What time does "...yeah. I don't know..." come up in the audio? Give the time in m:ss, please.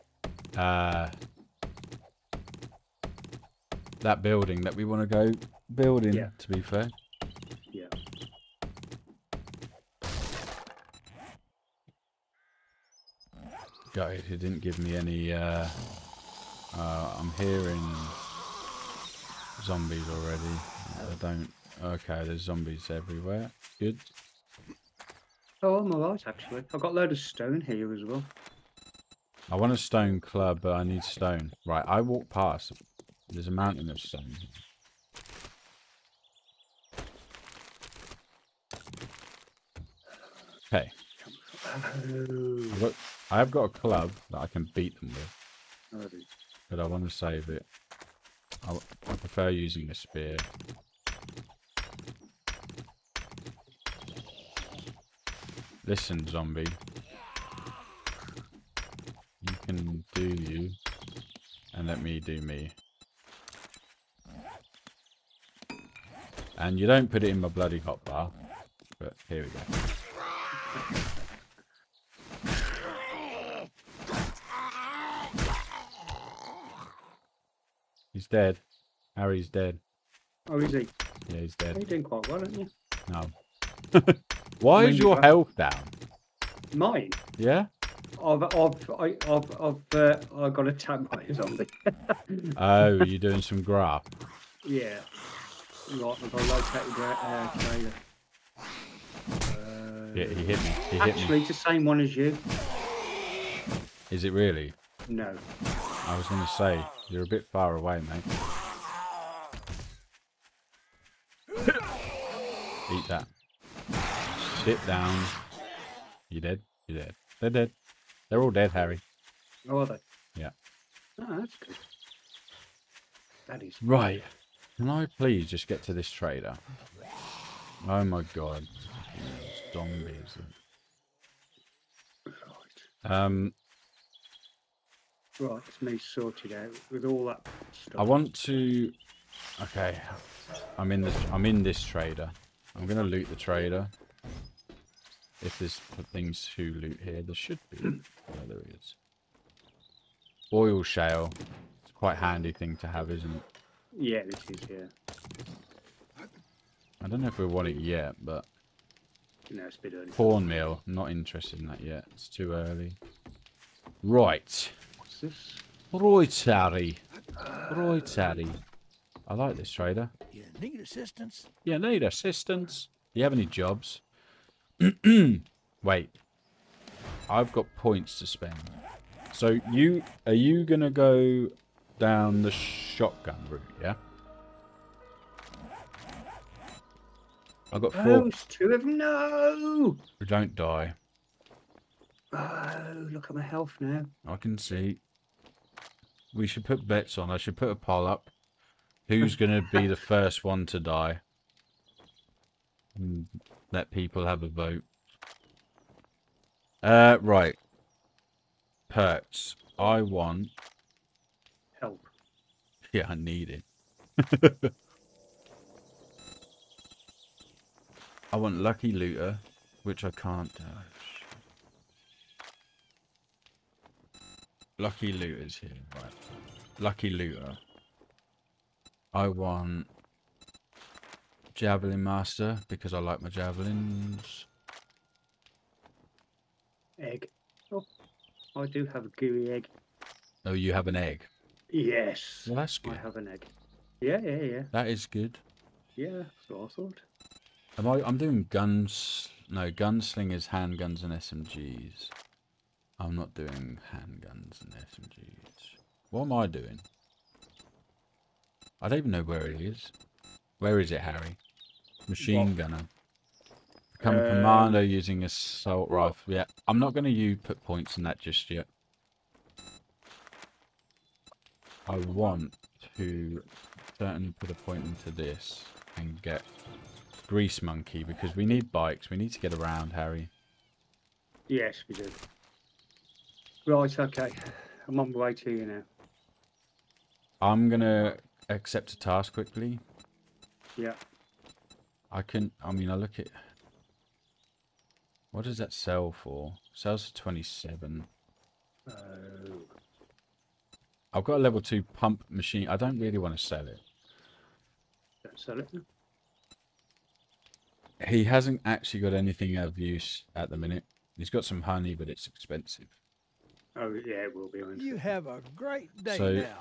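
2:34.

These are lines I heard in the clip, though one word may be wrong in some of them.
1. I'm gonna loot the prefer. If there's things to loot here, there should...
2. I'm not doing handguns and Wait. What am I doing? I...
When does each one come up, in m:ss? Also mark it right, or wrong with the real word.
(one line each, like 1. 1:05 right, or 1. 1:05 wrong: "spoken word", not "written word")
1. 2:22 wrong: "trader", not "prefer"
2. 4:12 wrong: "SMGs", not "Wait".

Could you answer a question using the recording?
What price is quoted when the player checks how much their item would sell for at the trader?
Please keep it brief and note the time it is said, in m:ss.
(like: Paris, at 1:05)
27, at 4:57.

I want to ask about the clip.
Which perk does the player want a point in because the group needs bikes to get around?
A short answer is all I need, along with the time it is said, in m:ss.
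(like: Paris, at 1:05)
Grease Monkey, at 4:37.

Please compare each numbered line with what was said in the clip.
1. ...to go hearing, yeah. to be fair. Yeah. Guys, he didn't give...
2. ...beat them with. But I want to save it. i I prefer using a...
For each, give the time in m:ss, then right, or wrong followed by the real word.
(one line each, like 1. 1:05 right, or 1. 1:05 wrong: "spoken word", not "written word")
1. 0:05 wrong: "building", not "hearing"
2. 0:44 right.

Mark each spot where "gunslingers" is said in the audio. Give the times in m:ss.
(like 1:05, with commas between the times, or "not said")
4:09.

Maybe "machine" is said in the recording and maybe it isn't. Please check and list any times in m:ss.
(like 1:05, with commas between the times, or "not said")
4:22, 5:02.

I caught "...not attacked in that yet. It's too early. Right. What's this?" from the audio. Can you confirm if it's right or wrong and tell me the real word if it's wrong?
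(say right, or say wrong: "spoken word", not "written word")
wrong: "interested", not "attacked".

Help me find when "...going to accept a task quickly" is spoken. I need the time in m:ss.
4:47.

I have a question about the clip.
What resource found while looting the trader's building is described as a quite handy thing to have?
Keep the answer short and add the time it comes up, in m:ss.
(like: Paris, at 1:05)
Oil shale, at 2:30.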